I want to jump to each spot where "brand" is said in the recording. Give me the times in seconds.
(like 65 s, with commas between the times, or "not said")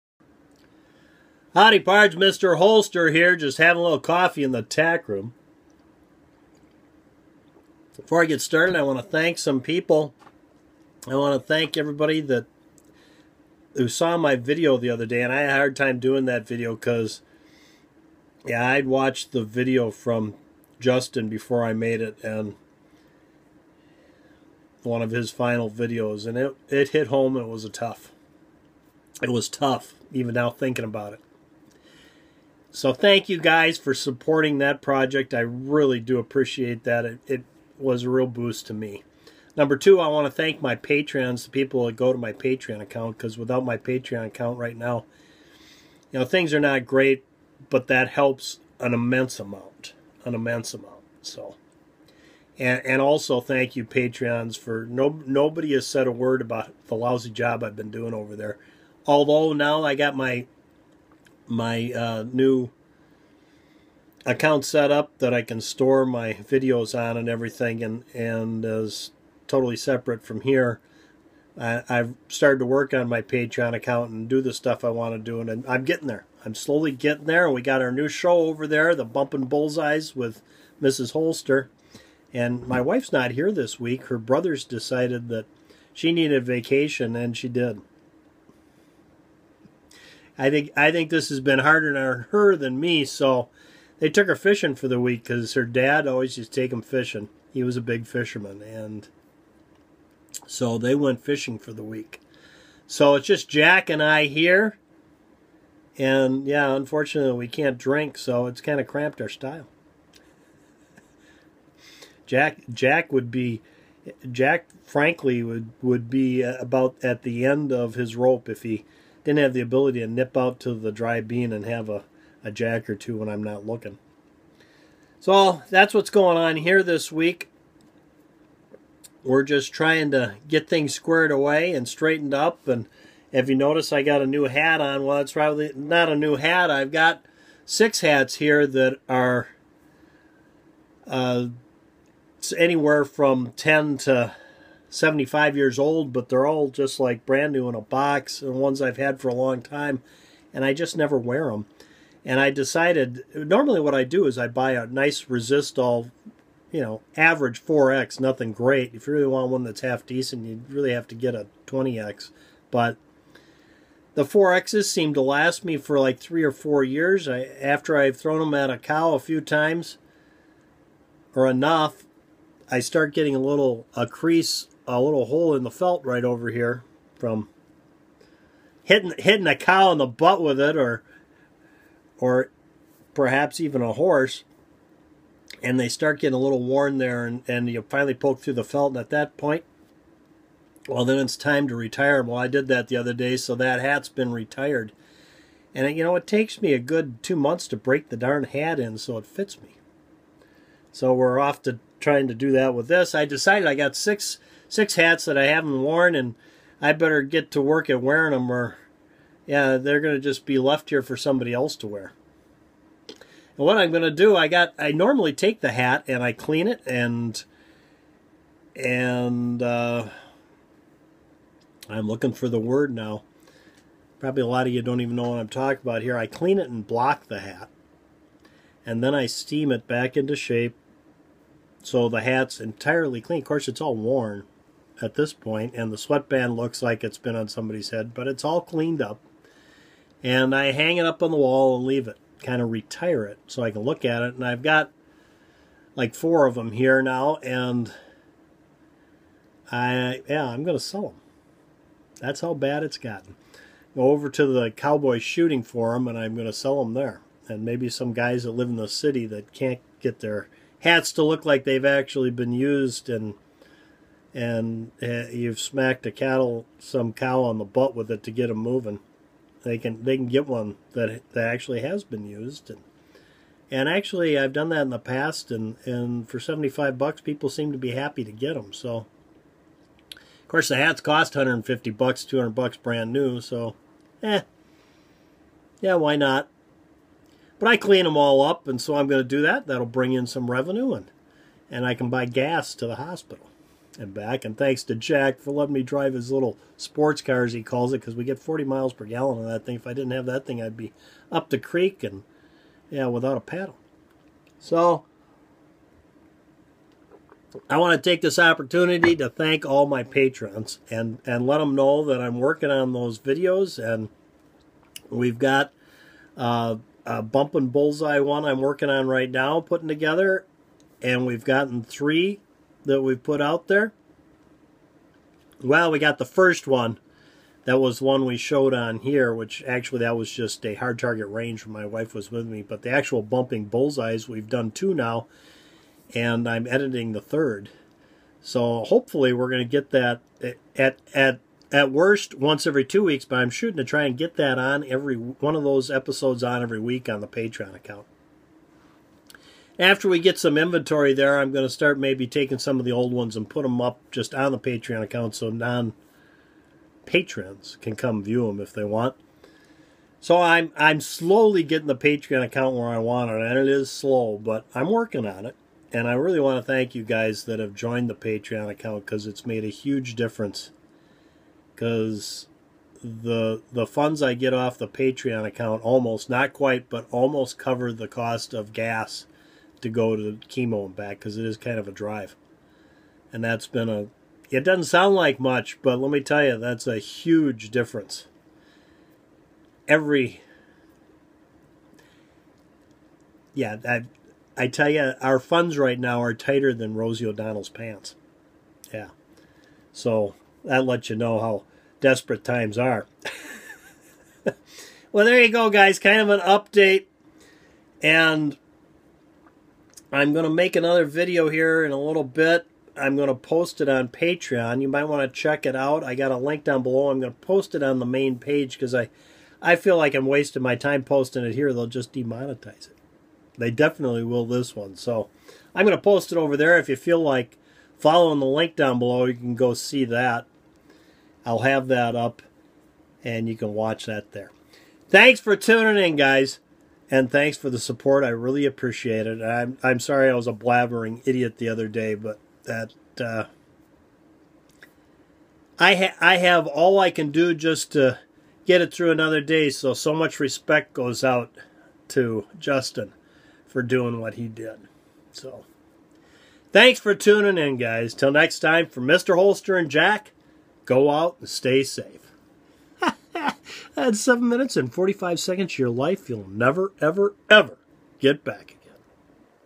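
147 s, 282 s.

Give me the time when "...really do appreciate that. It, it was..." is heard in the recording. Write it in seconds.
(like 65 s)
35 s.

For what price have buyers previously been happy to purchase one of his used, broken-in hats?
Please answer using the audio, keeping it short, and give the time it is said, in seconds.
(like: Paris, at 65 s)
$75, at 276 s.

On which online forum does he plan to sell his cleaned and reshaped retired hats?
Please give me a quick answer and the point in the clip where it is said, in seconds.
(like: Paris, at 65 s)
Cowboy Shooting Forum, at 254 s.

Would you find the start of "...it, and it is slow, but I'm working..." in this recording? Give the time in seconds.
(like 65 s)
363 s.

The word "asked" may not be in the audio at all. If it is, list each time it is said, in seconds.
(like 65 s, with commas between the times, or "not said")
not said.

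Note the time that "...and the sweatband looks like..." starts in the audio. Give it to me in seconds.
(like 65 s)
235 s.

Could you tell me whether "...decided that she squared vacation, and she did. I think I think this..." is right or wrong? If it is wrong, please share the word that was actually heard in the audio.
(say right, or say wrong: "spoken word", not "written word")
wrong: "needed", not "squared".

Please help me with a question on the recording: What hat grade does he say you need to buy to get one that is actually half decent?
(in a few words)
20X.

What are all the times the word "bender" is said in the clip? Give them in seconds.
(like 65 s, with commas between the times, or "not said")
not said.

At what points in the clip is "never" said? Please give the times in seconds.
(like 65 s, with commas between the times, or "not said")
150 s, 466 s.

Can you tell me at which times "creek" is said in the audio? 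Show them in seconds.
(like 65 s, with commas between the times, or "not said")
301 s.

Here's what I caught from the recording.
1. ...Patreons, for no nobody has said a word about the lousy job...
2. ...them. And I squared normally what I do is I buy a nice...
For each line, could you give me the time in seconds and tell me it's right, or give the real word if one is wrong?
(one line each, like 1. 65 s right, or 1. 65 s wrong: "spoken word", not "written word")
1. 53 s right
2. 151 s wrong: "decided", not "squared".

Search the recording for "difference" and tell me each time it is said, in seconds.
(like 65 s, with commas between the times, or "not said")
370 s, 387 s.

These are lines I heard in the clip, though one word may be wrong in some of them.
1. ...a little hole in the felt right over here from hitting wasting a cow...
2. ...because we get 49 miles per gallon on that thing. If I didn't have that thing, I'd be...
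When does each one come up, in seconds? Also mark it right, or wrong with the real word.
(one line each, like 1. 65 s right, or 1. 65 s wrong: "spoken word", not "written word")
1. 174 s wrong: "hitting", not "wasting"
2. 298 s wrong: "40", not "49".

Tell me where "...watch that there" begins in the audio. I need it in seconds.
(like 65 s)
433 s.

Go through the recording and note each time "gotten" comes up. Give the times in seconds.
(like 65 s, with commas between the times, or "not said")
252 s, 321 s.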